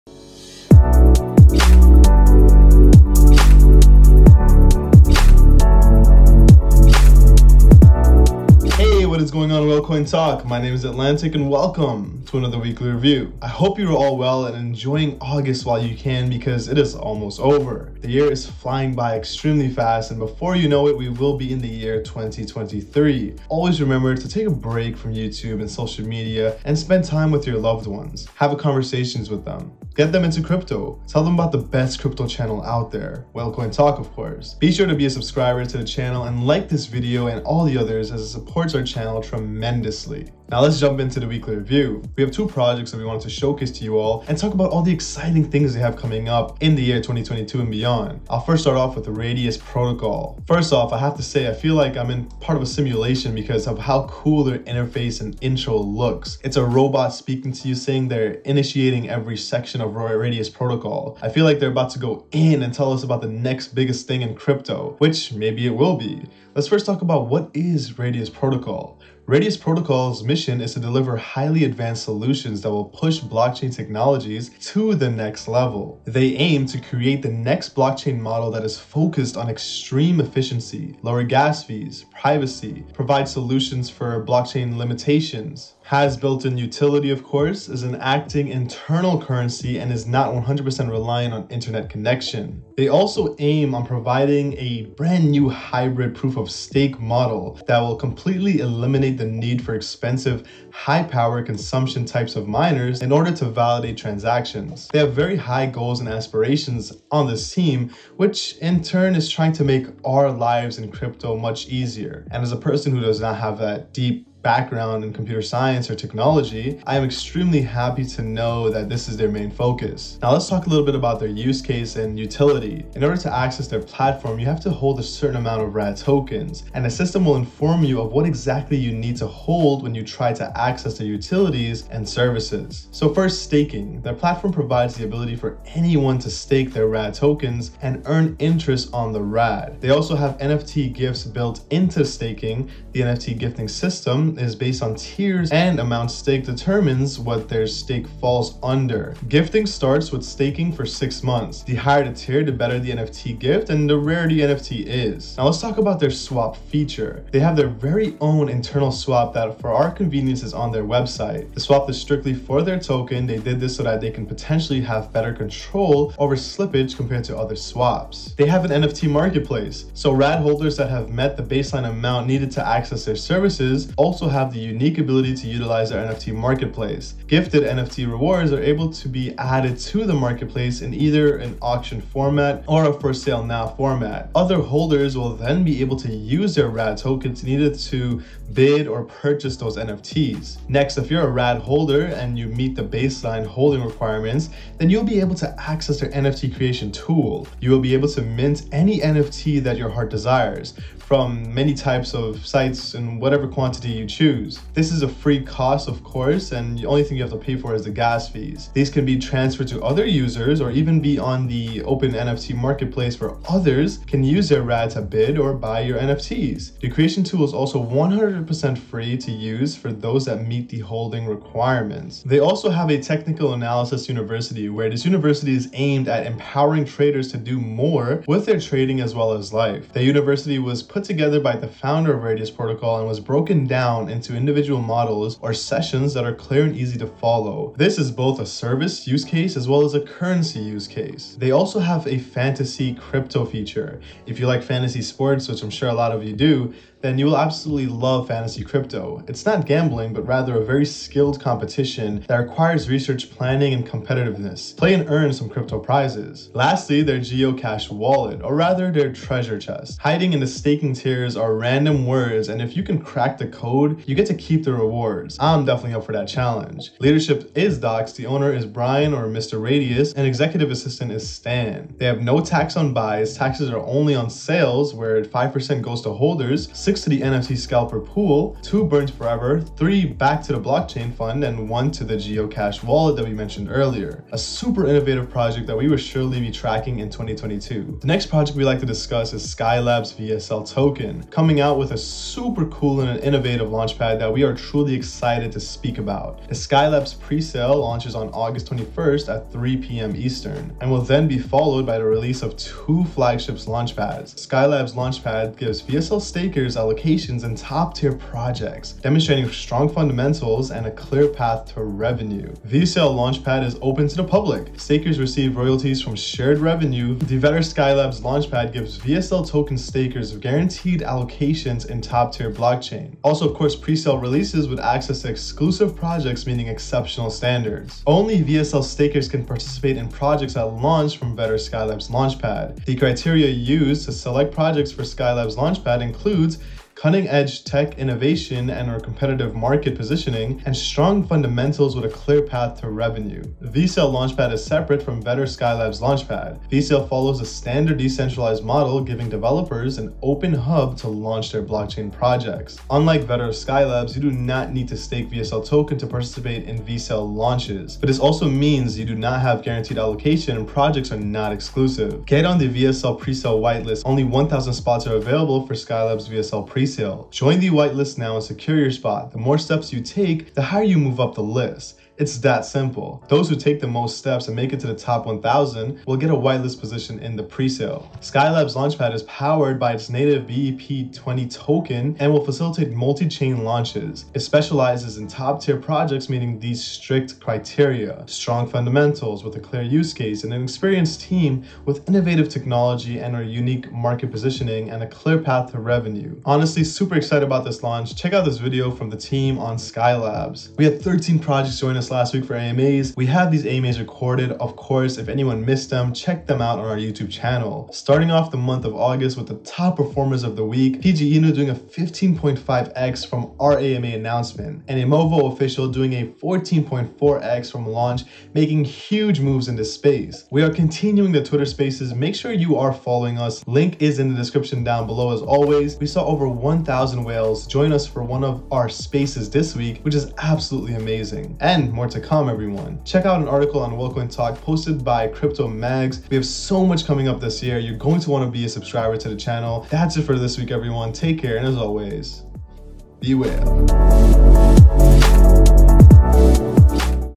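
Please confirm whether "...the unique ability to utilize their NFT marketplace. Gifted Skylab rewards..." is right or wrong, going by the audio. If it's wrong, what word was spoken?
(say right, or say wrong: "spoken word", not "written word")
wrong: "NFT", not "Skylab".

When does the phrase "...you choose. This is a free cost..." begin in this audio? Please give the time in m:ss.
3:23.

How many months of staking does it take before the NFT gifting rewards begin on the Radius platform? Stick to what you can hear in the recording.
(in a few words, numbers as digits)
6 months.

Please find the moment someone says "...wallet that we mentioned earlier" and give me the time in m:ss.
4:42.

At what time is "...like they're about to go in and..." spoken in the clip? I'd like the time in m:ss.
1:01.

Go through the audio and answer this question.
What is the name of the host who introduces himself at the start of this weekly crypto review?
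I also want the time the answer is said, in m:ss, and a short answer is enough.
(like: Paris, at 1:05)
Atlantic, at 0:10.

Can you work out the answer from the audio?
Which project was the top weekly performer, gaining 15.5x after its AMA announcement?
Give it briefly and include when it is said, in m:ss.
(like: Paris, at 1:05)
PG Inu, at 6:51.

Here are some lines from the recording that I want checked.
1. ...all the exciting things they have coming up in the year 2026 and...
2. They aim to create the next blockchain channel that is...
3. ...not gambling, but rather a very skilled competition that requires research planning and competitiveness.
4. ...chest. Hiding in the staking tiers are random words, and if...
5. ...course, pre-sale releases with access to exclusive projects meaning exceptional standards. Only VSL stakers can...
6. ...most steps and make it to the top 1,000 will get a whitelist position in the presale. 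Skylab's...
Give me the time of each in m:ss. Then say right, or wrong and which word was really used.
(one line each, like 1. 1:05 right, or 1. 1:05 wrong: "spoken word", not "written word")
1. 0:44 wrong: "2022", not "2026"
2. 1:16 wrong: "model", not "channel"
3. 4:09 right
4. 4:19 right
5. 5:23 right
6. 6:13 right.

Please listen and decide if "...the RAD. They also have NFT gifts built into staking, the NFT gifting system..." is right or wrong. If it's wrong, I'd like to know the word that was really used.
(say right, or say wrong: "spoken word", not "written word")
right.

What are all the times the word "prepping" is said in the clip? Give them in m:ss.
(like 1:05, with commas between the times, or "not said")
not said.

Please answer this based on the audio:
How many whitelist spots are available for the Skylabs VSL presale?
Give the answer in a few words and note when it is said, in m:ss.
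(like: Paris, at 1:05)
1,000, at 6:04.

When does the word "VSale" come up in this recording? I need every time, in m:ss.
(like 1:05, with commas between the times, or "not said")
5:12.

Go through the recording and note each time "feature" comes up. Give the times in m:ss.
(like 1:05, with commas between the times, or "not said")
2:36, 4:03.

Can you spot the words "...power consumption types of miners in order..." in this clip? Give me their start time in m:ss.
1:41.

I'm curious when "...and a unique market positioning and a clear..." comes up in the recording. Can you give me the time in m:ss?
6:33.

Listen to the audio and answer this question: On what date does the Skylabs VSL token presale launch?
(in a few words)
August 21st.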